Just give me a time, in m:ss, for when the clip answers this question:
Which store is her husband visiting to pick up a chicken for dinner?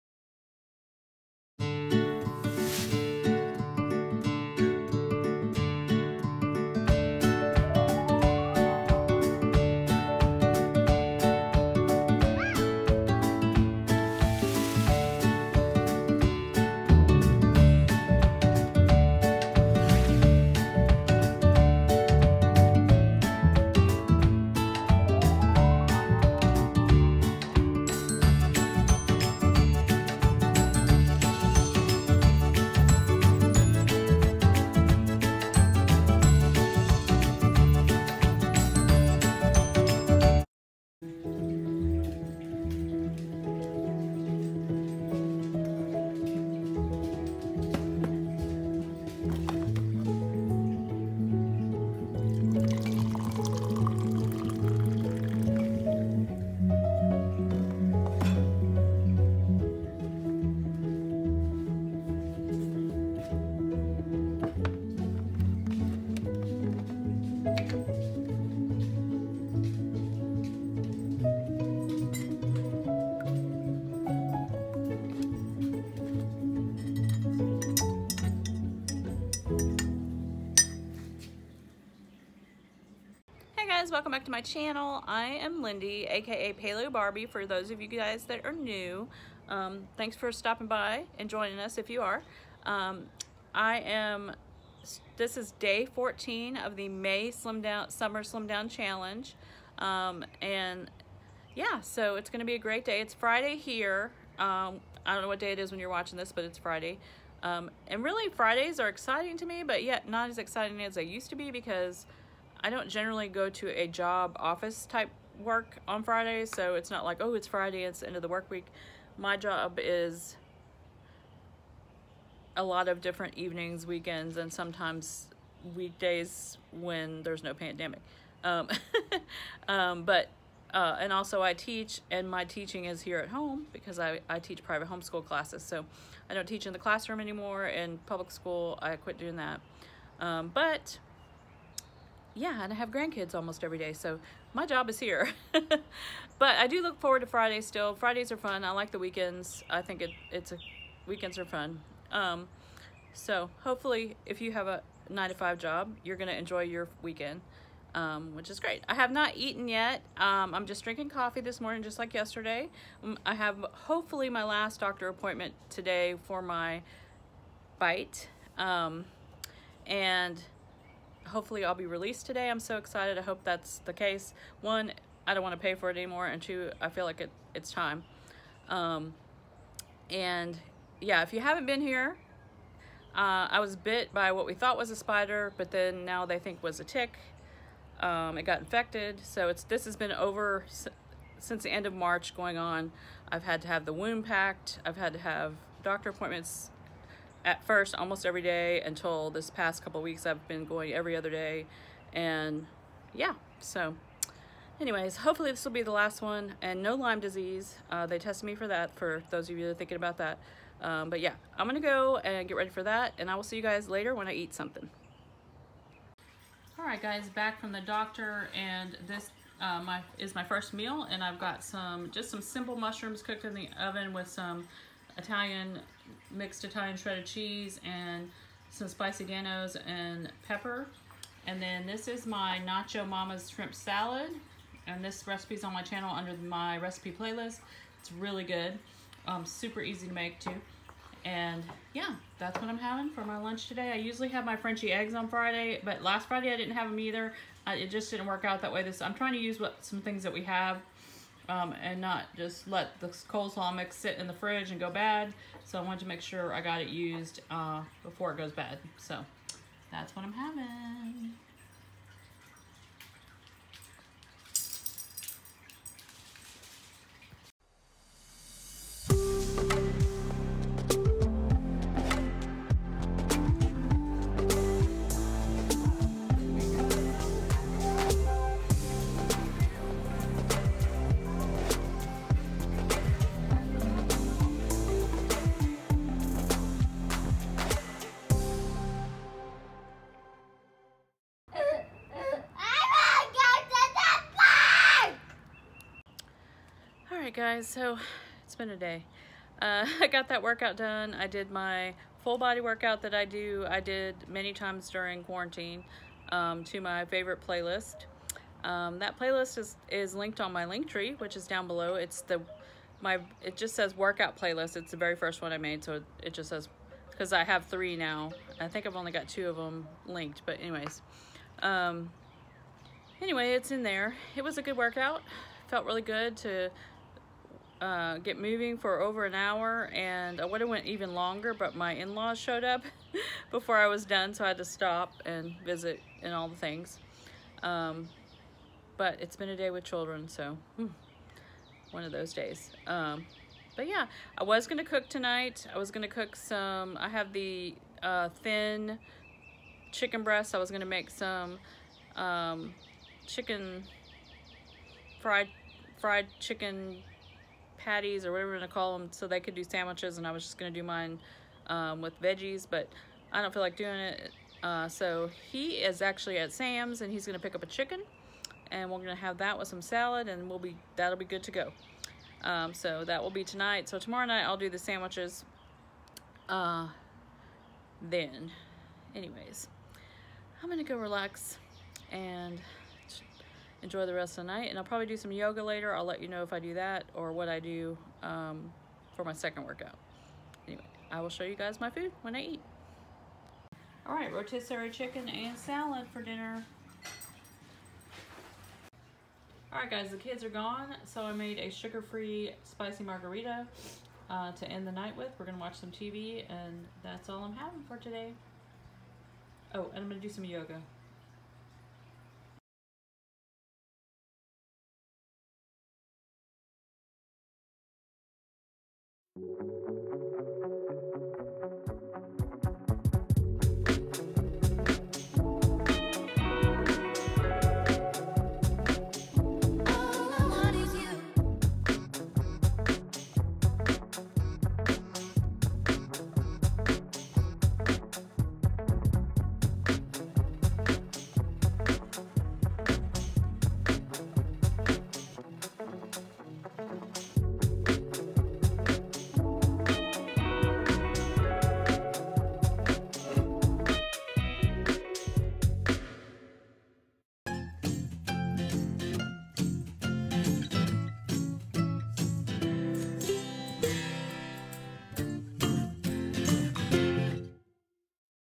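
6:06.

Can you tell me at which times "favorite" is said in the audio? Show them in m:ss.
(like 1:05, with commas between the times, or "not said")
5:07.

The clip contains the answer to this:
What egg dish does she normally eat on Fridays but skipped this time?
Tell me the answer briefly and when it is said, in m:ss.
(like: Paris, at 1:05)
Frenchy eggs, at 4:04.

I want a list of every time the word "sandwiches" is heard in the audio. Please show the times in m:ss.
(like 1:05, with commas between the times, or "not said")
5:59, 6:14.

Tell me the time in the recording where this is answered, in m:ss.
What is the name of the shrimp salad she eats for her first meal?
3:52.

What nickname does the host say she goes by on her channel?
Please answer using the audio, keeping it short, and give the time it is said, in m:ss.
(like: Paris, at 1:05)
Paleo Barbie, at 1:26.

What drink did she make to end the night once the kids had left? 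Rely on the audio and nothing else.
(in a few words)
sugar-free spicy margarita.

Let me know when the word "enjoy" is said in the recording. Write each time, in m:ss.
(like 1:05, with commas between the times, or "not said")
2:36, 6:23.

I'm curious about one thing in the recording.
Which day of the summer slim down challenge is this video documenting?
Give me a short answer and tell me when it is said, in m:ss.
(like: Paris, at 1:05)
14, at 1:35.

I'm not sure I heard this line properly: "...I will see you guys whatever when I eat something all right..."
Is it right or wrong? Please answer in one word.
wrong.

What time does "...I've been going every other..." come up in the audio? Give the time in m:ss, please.
3:20.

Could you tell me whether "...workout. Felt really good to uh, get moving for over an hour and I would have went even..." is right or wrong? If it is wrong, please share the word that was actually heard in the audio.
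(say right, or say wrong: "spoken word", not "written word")
right.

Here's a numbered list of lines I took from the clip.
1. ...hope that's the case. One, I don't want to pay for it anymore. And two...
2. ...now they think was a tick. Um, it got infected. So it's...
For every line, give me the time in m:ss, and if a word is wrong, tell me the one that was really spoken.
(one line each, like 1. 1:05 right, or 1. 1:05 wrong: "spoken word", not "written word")
1. 2:53 right
2. 3:06 right.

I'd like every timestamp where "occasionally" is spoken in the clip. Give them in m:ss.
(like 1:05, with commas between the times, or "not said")
not said.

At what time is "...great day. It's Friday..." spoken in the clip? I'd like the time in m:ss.
1:42.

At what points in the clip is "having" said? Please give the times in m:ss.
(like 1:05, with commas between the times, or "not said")
4:02, 4:20, 6:47.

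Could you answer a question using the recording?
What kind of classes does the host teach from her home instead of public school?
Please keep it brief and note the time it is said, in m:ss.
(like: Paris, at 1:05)
private homeschool classes, at 2:14.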